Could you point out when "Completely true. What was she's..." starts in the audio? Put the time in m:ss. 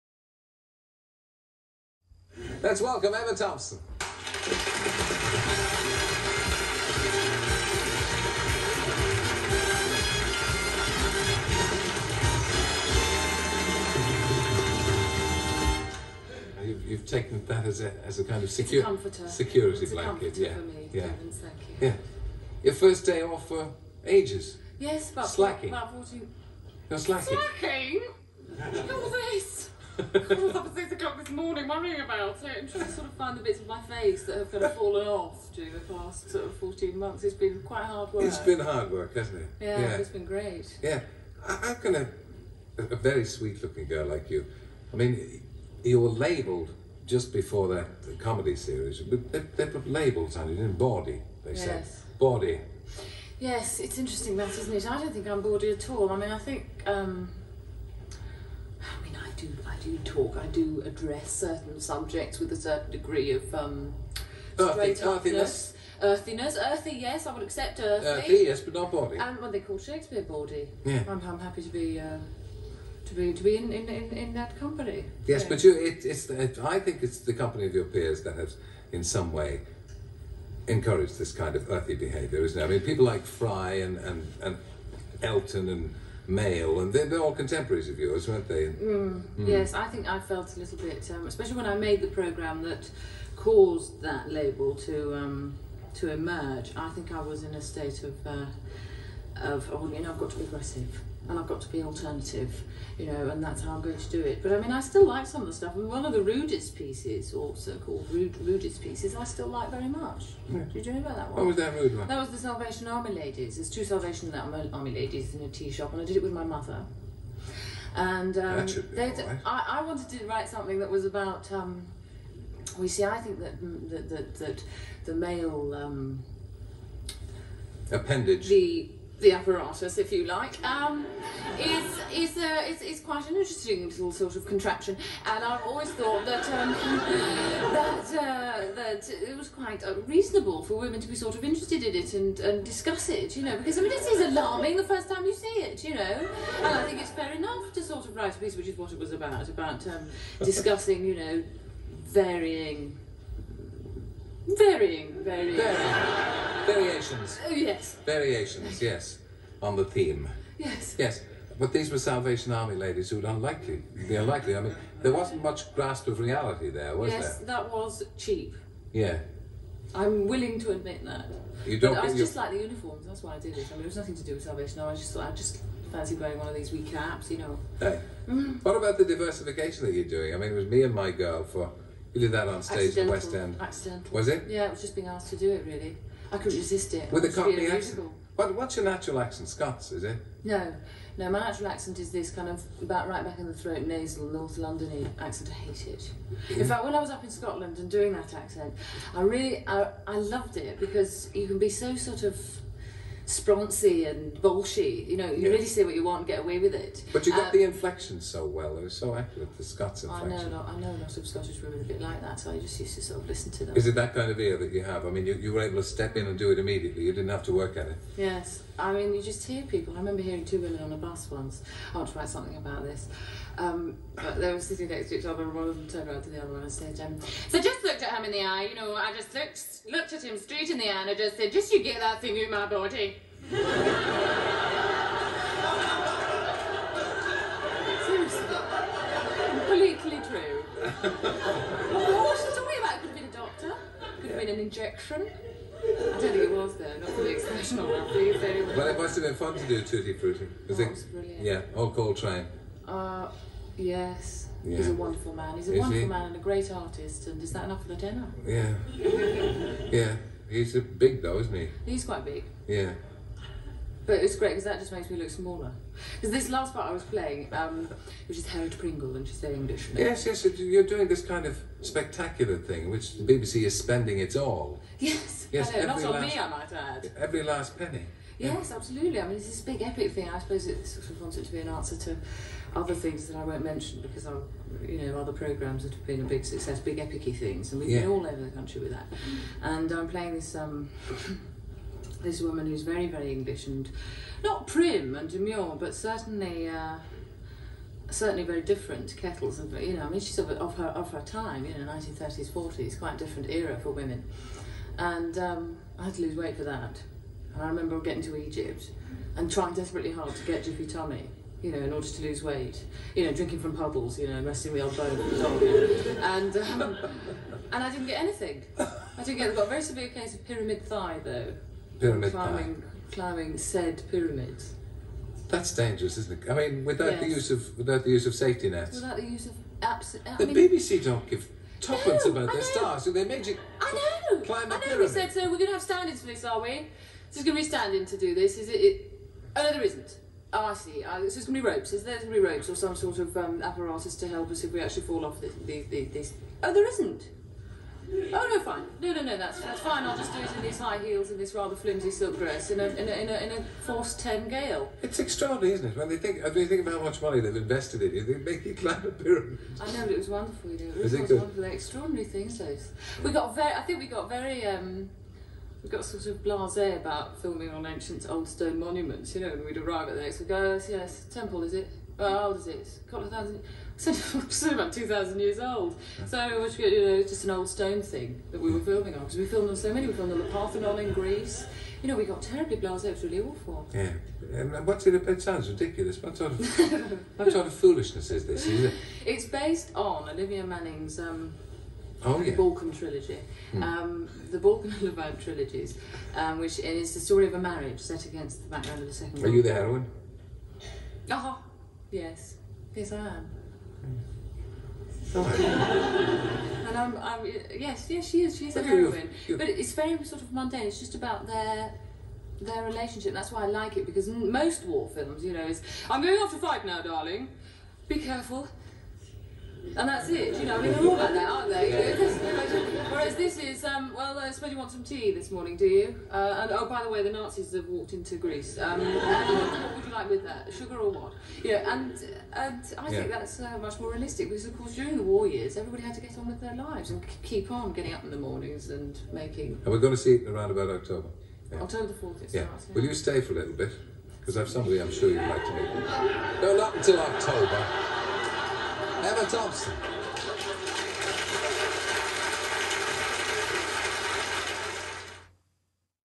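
3:59.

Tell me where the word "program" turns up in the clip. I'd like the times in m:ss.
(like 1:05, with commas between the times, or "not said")
1:32, 4:45.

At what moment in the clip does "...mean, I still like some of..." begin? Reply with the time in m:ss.
1:44.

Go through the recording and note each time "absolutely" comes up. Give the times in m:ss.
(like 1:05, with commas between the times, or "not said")
4:38, 5:29.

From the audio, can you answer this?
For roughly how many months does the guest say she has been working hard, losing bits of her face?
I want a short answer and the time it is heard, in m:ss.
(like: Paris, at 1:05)
14, at 0:36.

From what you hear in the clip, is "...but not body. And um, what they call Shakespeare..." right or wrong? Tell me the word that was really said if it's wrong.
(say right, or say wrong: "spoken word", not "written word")
right.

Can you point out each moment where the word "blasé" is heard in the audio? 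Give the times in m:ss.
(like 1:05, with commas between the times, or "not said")
6:06, 6:22.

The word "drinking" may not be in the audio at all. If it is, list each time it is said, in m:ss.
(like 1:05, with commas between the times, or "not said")
5:13.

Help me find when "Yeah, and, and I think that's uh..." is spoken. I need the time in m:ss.
7:11.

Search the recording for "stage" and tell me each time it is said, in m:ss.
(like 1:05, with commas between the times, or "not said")
3:02.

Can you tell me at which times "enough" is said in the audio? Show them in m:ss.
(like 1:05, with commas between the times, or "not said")
2:27, 4:17.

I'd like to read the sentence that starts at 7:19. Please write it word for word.
And we're going to see it around about October.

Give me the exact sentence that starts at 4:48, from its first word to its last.
been all over the country with that.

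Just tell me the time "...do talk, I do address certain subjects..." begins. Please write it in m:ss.
0:59.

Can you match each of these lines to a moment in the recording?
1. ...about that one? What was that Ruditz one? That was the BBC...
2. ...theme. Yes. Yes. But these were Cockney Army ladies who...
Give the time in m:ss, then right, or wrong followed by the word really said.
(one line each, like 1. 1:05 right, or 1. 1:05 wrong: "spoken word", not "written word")
1. 1:50 wrong: "Salvation", not "BBC"
2. 2:39 wrong: "Salvation", not "Cockney".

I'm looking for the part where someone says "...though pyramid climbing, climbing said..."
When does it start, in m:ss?
5:21.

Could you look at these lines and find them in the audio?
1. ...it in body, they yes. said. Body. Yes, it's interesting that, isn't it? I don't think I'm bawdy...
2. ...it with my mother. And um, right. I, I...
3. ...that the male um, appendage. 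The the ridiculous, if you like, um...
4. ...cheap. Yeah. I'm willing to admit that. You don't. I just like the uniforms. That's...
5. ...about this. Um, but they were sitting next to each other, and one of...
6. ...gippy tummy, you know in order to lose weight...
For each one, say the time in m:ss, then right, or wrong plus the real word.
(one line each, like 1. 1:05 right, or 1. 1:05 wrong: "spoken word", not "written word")
1. 0:50 right
2. 1:56 right
3. 2:04 wrong: "apparatus", not "ridiculous"
4. 2:48 right
5. 3:42 right
6. 5:10 right.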